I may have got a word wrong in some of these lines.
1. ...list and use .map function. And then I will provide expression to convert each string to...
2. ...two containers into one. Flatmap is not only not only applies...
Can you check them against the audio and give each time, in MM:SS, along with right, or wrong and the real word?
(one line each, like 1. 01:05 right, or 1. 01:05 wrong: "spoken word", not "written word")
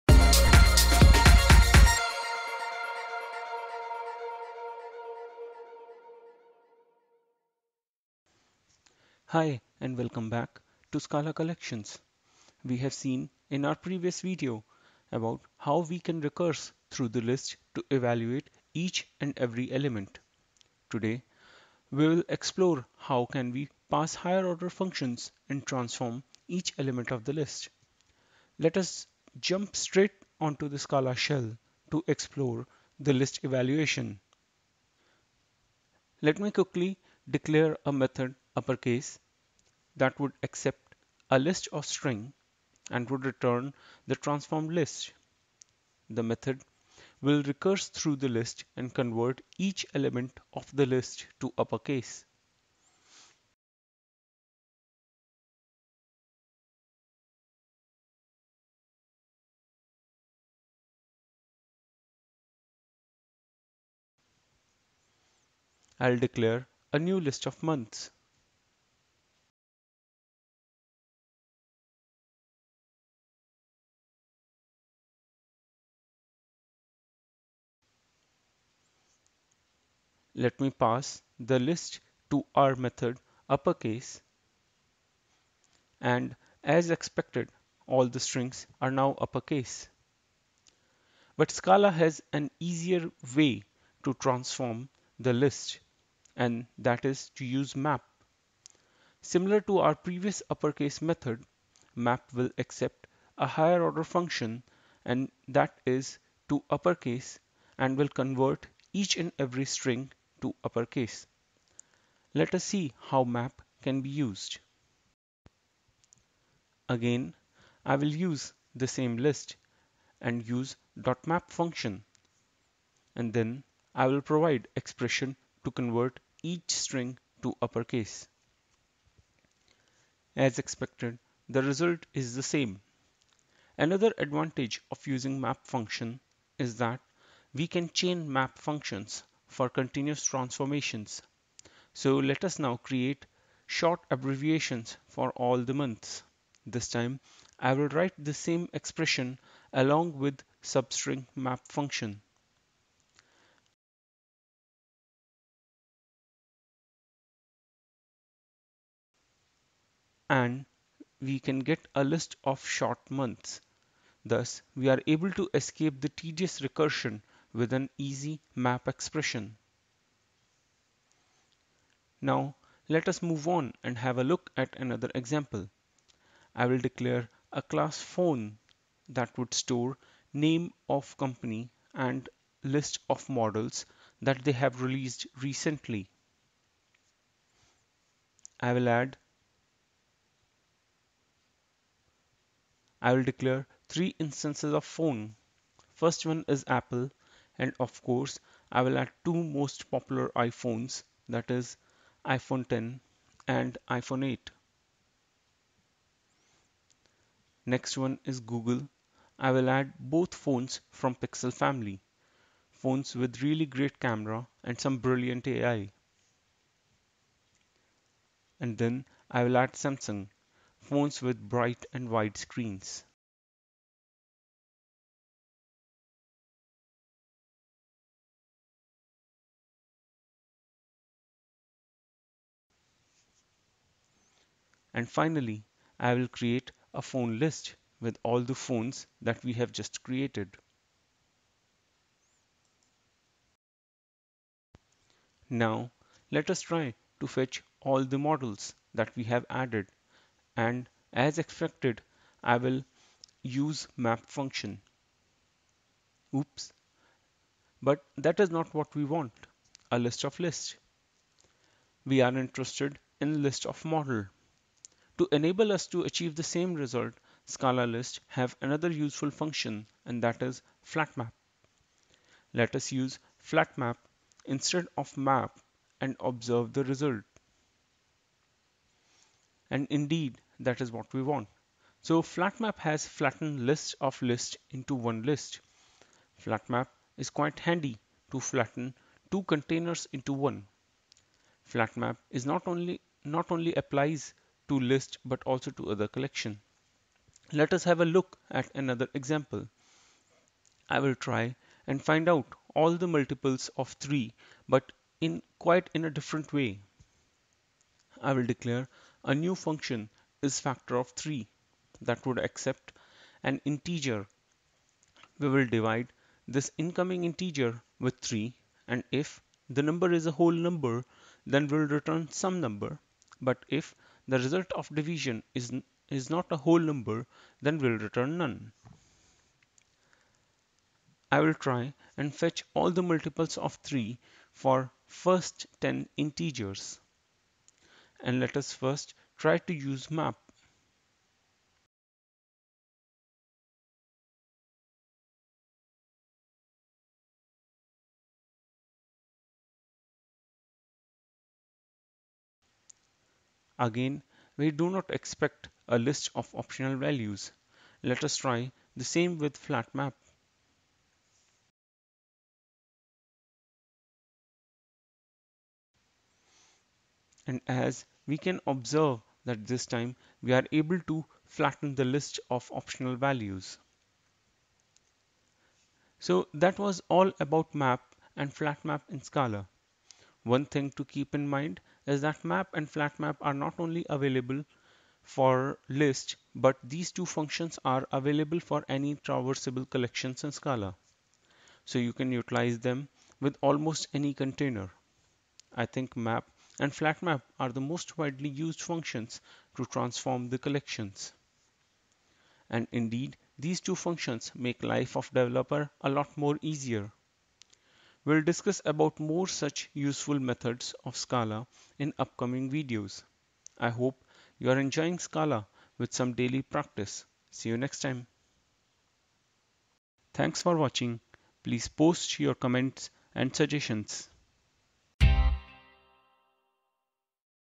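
1. 01:59 right
2. 04:49 right.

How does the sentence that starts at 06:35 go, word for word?
I think map and flatmap are the most widely used functions to transform the collections.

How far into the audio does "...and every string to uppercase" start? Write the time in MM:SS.
01:49.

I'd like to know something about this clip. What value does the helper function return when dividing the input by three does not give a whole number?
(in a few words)
None.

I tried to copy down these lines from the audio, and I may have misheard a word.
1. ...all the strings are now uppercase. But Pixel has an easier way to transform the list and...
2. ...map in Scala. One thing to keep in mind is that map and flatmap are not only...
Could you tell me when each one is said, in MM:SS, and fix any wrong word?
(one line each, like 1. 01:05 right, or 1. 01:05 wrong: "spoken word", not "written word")
1. 01:27 wrong: "Scala", not "Pixel"
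2. 06:18 right.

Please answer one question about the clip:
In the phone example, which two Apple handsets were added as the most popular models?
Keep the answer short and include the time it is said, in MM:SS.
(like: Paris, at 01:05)
iPhone 10 and iPhone 8, at 03:22.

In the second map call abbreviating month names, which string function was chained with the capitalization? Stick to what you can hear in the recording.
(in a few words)
substring.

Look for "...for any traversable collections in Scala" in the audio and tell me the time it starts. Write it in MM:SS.
06:28.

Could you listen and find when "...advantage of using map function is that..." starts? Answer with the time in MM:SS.
02:14.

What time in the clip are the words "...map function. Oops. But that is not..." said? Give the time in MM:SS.
04:13.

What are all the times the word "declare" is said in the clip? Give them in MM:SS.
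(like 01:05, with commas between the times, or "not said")
00:37, 01:06, 02:56, 03:13, 05:08.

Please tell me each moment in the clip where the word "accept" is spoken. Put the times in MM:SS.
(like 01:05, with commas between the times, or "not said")
00:40, 01:42, 05:12.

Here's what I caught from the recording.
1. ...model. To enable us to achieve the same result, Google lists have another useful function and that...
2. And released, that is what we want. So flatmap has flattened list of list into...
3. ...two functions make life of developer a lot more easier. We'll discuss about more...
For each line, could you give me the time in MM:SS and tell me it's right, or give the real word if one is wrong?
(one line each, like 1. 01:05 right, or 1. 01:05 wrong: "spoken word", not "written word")
1. 04:23 wrong: "Scala", not "Google"
2. 04:39 wrong: "indeed", not "released"
3. 06:43 right.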